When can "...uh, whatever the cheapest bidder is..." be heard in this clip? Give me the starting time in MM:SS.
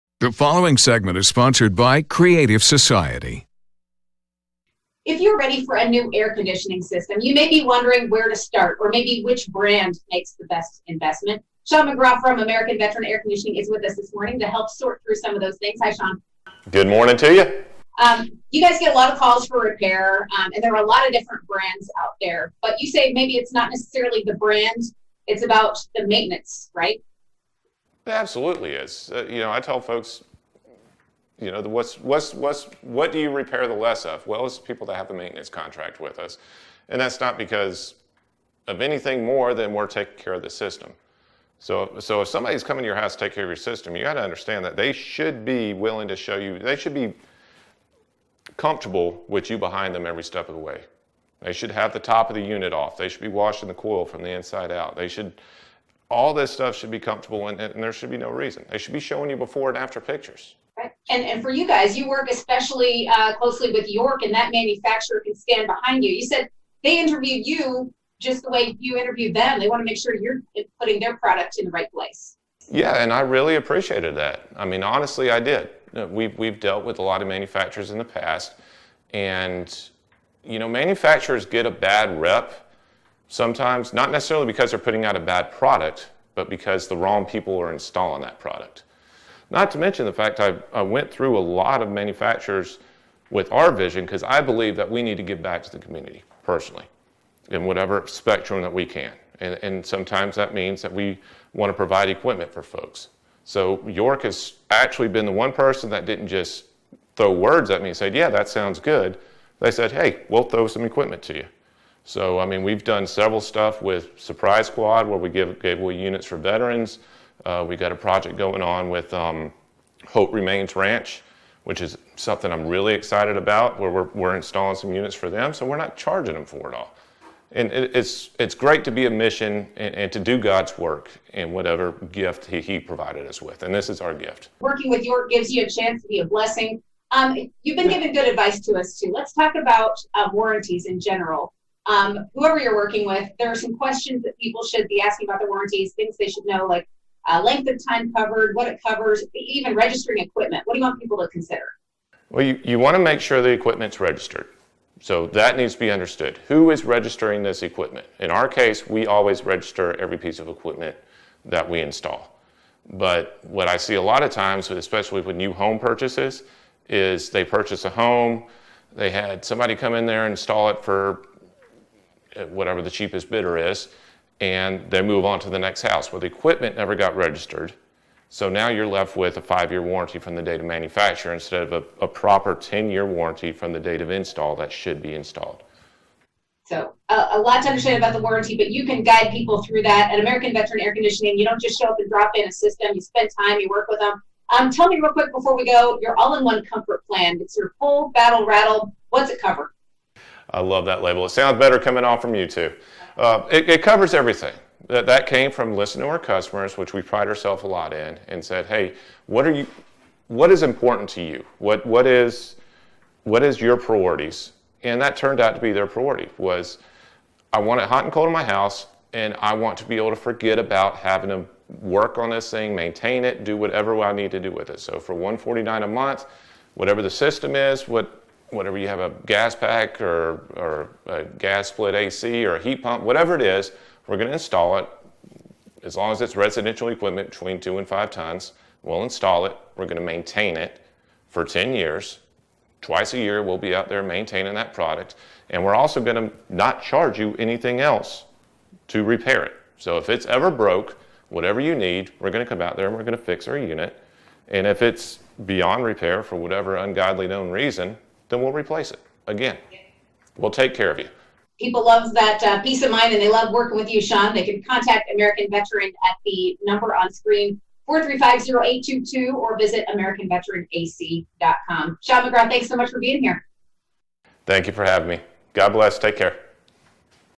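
02:52.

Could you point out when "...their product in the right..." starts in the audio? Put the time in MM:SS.
01:10.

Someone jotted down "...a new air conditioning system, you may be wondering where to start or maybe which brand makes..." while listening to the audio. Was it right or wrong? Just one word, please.
right.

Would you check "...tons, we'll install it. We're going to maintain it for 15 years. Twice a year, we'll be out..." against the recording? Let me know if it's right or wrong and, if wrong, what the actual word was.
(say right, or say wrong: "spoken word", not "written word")
wrong: "10", not "15".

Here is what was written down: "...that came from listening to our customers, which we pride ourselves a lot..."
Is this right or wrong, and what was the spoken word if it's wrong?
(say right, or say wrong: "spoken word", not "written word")
right.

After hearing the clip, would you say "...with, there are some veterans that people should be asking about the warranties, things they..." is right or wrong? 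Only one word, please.
wrong.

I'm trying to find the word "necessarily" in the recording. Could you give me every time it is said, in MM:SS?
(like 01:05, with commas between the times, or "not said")
00:23, 01:24.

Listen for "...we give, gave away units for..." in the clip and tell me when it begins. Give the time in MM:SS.
01:55.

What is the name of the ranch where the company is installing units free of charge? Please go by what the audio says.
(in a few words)
Hope Remains Ranch.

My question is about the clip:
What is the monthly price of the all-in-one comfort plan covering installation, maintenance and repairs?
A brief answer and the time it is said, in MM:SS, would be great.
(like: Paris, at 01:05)
149, at 03:45.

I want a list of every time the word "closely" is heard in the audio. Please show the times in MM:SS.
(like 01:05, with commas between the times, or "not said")
01:03.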